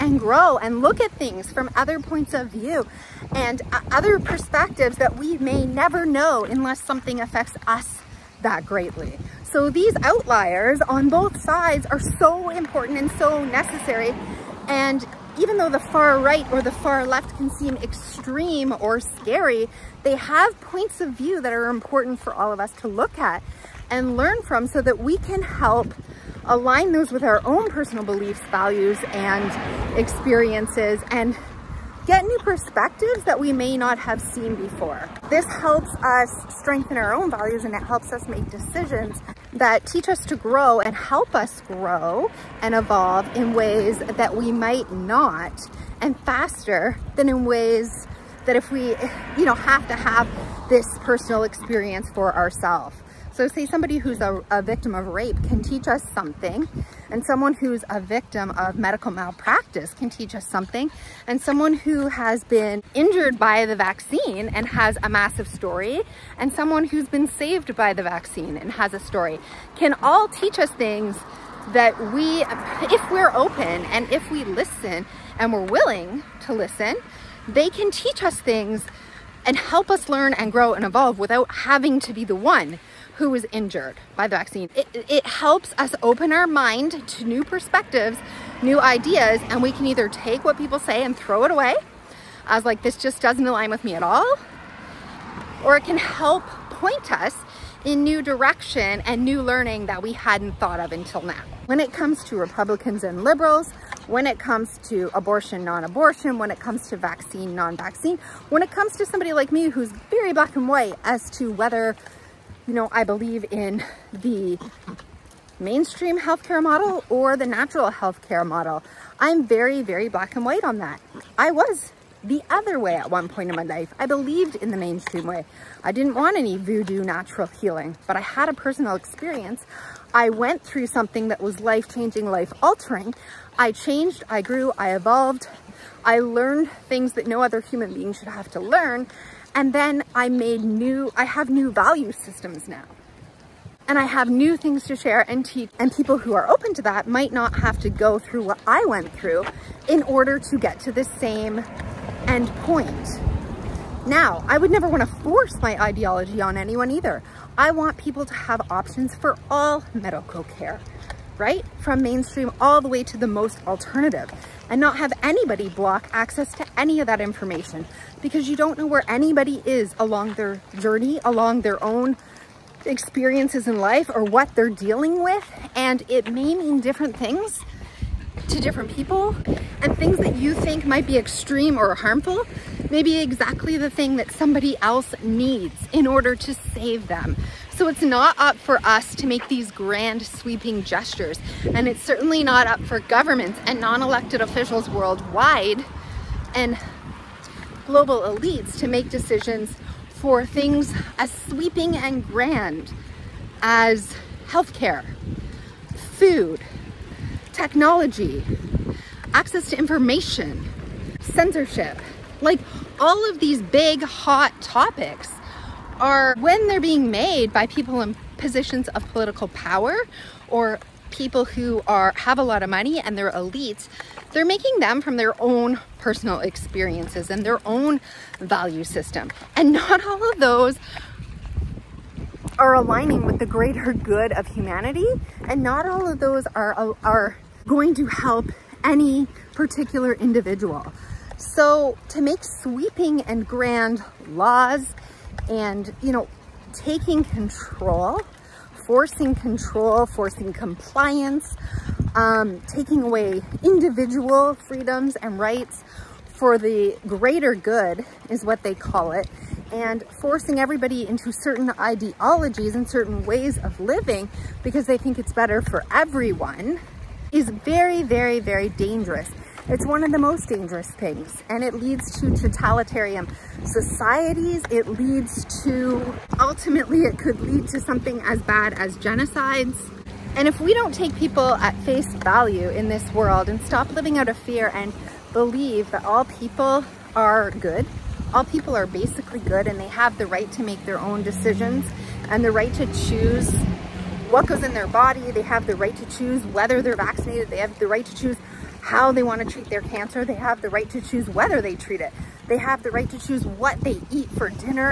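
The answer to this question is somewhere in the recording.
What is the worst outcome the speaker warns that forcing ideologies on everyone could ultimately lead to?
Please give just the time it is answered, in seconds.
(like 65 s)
278 s.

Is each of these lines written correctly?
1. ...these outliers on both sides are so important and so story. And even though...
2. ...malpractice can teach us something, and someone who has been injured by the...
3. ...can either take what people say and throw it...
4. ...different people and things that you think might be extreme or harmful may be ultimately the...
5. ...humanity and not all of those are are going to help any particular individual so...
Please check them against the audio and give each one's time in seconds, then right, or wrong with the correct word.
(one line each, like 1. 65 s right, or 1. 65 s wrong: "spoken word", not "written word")
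1. 9 s wrong: "necessary", not "story"
2. 59 s right
3. 89 s right
4. 178 s wrong: "exactly", not "ultimately"
5. 234 s right.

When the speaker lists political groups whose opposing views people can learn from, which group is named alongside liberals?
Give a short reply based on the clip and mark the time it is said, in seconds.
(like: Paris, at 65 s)
Republicans, at 102 s.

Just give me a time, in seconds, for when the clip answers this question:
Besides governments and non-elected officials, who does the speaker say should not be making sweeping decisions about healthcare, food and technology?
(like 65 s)
197 s.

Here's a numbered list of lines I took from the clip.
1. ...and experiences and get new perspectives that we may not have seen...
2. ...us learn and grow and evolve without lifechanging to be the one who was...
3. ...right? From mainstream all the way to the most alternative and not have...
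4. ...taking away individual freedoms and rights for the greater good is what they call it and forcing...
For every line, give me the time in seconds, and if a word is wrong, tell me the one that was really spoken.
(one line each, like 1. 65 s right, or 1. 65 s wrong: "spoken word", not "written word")
1. 29 s right
2. 79 s wrong: "having", not "lifechanging"
3. 161 s right
4. 252 s right.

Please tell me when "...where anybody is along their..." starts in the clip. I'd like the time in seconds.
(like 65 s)
168 s.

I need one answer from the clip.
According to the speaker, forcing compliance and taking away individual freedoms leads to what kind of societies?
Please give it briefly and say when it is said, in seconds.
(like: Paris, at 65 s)
totalitarian, at 272 s.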